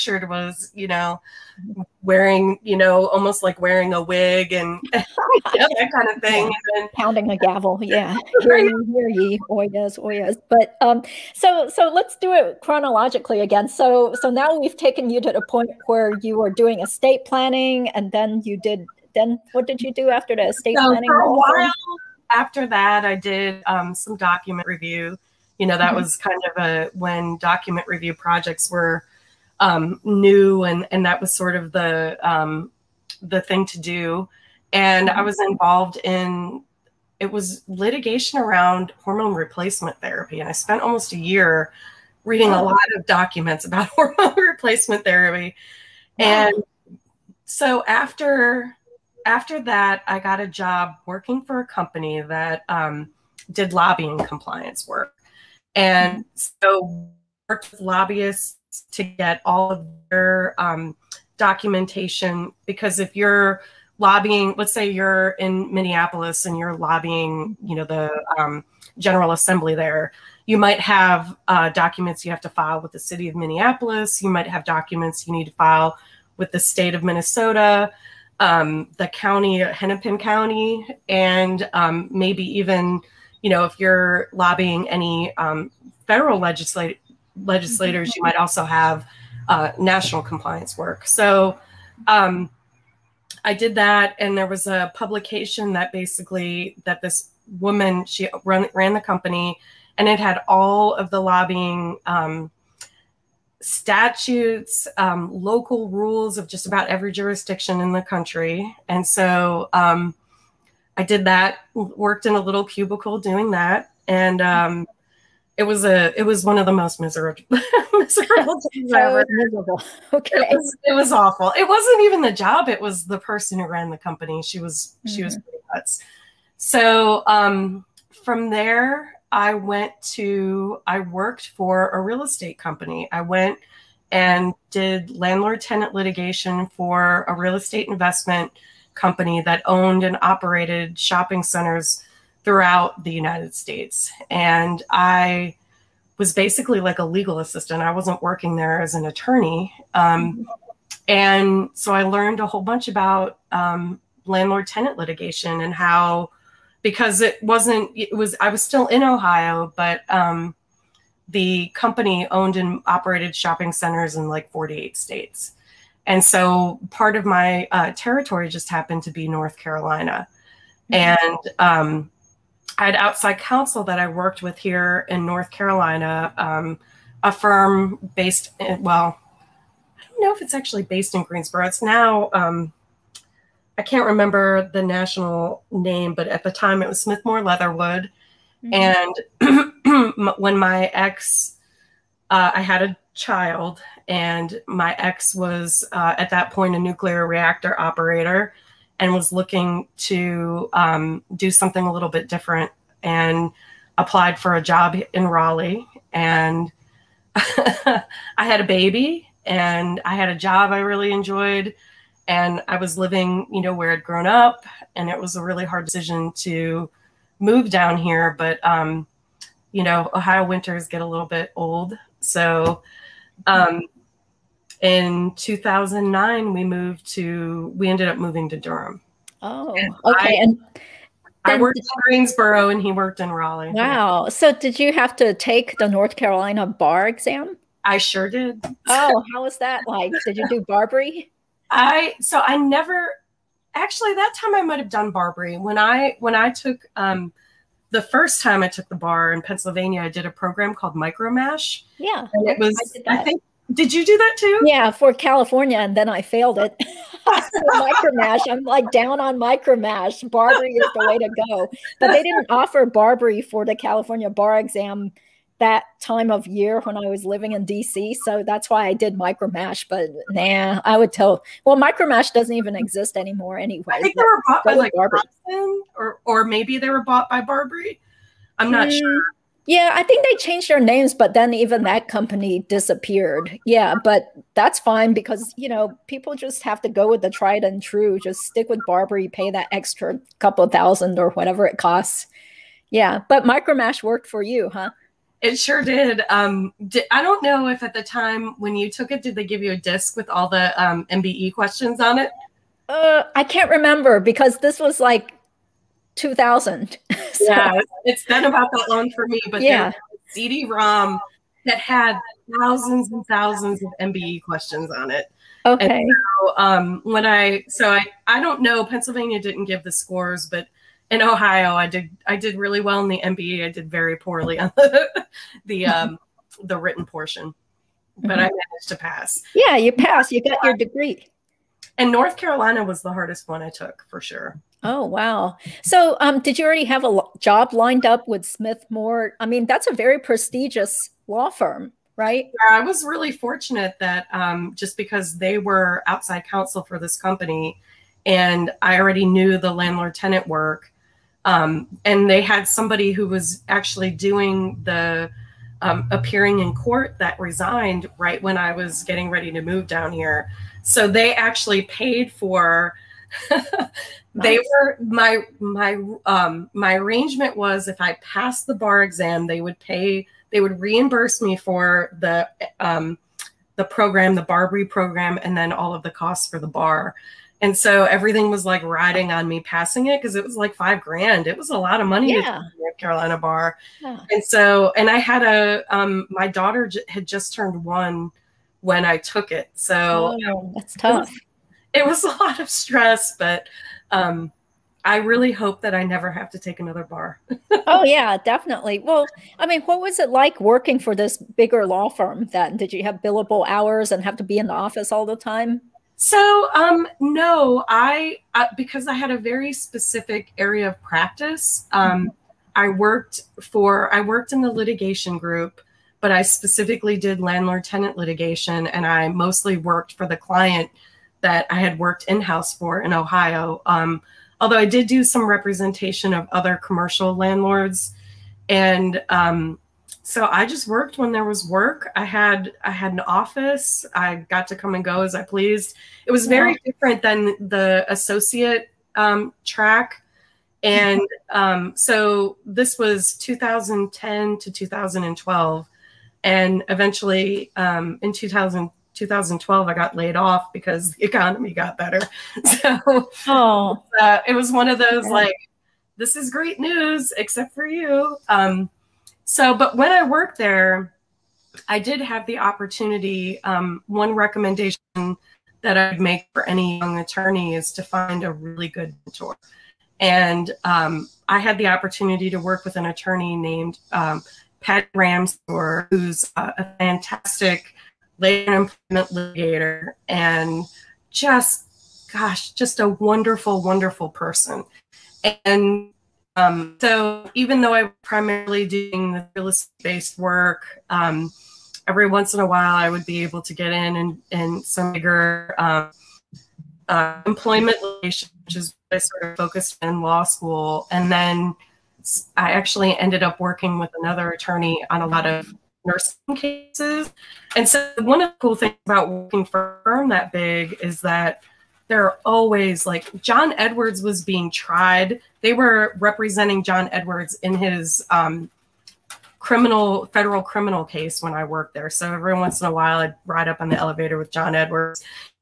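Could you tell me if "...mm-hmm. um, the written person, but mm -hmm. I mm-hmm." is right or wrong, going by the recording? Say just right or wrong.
wrong.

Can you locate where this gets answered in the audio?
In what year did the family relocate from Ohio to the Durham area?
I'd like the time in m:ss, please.
3:45.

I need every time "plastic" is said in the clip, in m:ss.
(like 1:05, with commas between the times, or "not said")
not said.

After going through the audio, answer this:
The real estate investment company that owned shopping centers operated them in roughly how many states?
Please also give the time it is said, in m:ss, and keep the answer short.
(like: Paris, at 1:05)
48, at 2:44.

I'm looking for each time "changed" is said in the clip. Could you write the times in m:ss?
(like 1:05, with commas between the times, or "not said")
4:40.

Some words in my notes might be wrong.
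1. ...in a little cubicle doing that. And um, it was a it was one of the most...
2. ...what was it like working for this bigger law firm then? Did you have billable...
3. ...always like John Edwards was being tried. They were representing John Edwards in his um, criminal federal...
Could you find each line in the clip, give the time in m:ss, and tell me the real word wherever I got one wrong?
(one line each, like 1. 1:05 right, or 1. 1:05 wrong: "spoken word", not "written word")
1. 1:52 right
2. 6:39 right
3. 8:32 right.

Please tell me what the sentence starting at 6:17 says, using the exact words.
And so everything was like riding on me passing it because it was like five grand.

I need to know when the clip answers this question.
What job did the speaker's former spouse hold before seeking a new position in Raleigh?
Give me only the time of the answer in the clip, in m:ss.
3:16.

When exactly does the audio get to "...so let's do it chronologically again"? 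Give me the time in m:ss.
0:11.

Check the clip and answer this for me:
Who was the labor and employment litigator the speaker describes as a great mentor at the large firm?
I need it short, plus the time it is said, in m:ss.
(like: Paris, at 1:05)
Pat Rams, at 7:54.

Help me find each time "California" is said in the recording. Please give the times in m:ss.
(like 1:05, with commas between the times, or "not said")
4:15, 4:23.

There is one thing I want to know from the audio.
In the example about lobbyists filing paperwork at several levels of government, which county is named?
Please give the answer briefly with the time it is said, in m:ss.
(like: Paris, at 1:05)
Hennepin County, at 1:19.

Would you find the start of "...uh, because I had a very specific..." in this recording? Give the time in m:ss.
6:48.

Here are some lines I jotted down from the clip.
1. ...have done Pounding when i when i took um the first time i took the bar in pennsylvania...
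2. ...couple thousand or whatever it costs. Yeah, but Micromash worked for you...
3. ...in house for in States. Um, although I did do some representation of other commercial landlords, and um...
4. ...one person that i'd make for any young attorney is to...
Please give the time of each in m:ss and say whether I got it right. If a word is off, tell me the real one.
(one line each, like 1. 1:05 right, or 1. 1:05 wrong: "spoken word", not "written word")
1. 4:04 wrong: "BarBri", not "Pounding"
2. 4:50 right
3. 7:02 wrong: "Ohio", not "States"
4. 7:44 wrong: "recommendation", not "person".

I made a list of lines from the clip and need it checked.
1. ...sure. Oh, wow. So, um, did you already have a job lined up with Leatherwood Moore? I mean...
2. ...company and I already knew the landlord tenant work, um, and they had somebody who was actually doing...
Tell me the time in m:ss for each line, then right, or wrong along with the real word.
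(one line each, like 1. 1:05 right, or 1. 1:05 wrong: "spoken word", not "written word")
1. 5:34 wrong: "Smith", not "Leatherwood"
2. 5:47 right.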